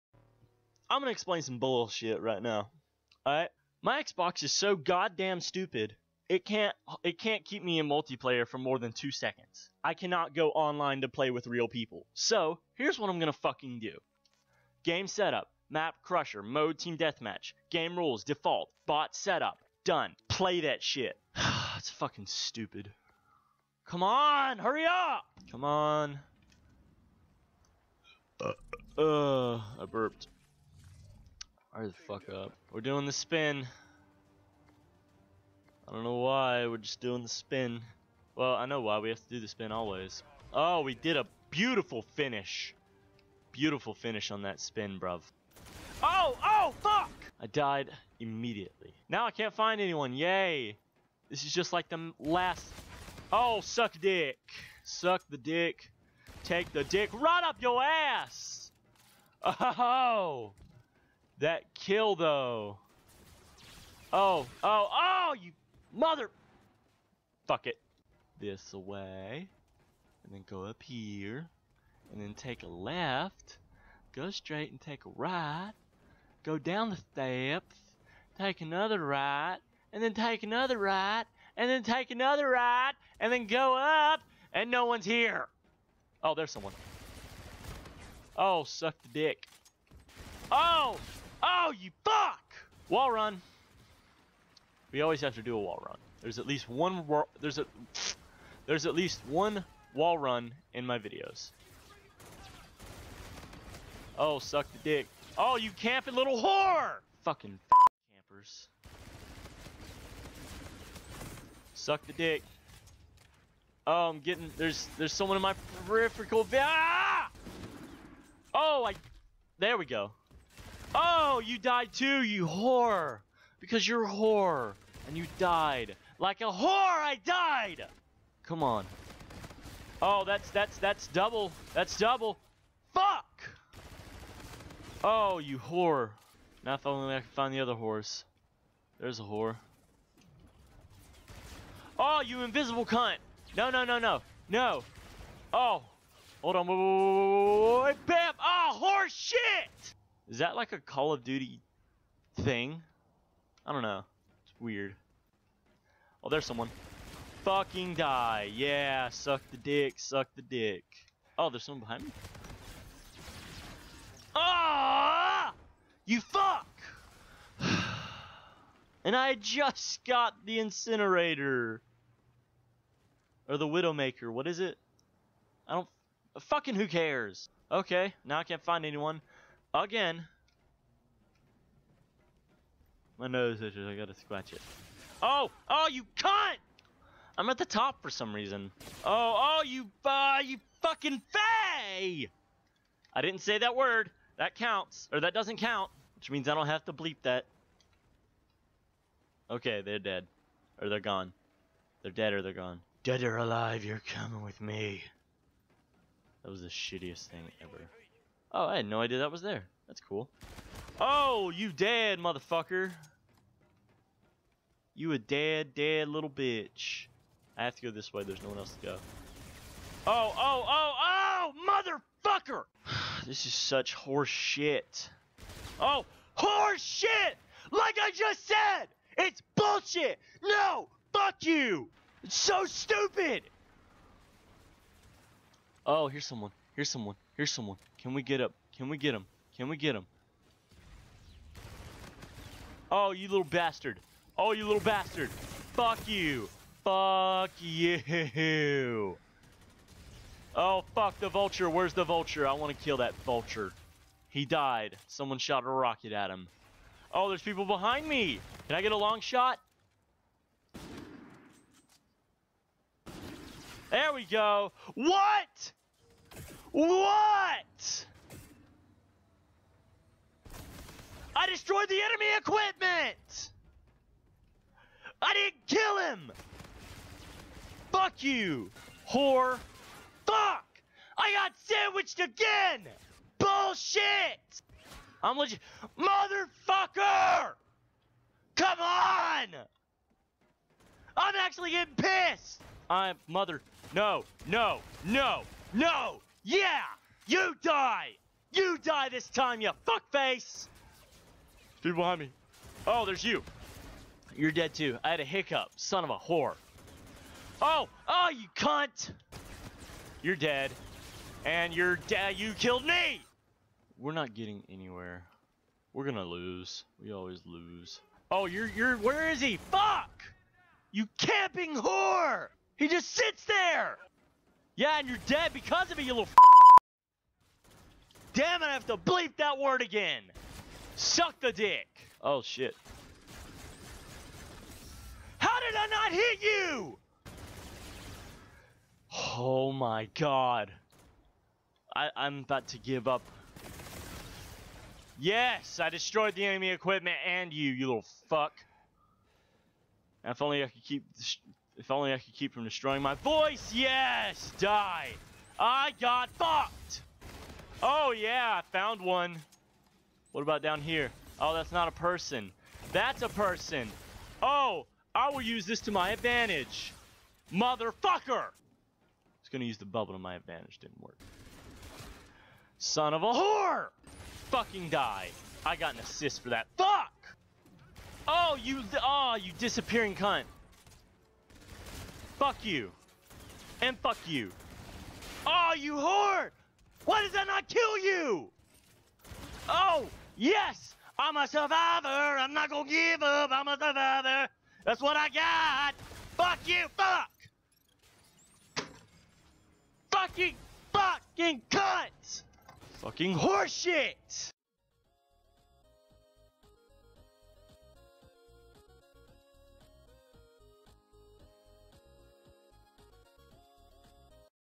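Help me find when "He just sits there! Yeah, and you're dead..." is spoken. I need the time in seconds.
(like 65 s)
322 s.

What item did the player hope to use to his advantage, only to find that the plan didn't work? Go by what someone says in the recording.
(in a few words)
Bubble.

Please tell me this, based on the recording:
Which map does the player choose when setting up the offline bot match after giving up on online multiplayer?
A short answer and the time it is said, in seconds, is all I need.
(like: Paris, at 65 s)
Crusher, at 15 s.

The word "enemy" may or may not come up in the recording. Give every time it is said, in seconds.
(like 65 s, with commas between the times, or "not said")
272 s, 346 s.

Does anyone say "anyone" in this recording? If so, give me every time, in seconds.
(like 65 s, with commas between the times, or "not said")
49 s, 178 s.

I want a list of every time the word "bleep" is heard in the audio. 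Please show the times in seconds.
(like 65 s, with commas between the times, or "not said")
196 s, 328 s.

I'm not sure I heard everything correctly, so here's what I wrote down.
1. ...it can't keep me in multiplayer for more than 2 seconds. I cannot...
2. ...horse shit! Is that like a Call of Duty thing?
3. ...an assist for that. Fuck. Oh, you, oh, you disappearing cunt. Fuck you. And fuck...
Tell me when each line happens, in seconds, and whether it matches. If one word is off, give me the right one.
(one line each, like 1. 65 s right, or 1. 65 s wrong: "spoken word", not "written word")
1. 7 s right
2. 148 s right
3. 375 s right.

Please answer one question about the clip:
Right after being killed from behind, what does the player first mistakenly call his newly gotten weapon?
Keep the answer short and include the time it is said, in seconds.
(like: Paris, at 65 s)
Incinerator, at 170 s.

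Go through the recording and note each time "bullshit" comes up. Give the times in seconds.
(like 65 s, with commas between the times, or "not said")
1 s, 229 s, 283 s.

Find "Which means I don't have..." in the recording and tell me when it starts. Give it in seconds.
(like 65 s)
196 s.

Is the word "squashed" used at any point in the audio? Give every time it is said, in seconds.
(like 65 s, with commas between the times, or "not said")
not said.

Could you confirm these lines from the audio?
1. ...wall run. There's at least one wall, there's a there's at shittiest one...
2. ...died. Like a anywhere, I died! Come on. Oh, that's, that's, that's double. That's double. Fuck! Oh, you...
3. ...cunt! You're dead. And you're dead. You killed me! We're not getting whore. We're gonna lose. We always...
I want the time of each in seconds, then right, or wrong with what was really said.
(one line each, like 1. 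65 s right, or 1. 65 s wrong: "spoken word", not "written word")
1. 95 s wrong: "least", not "shittiest"
2. 125 s wrong: "whore", not "anywhere"
3. 308 s wrong: "anywhere", not "whore".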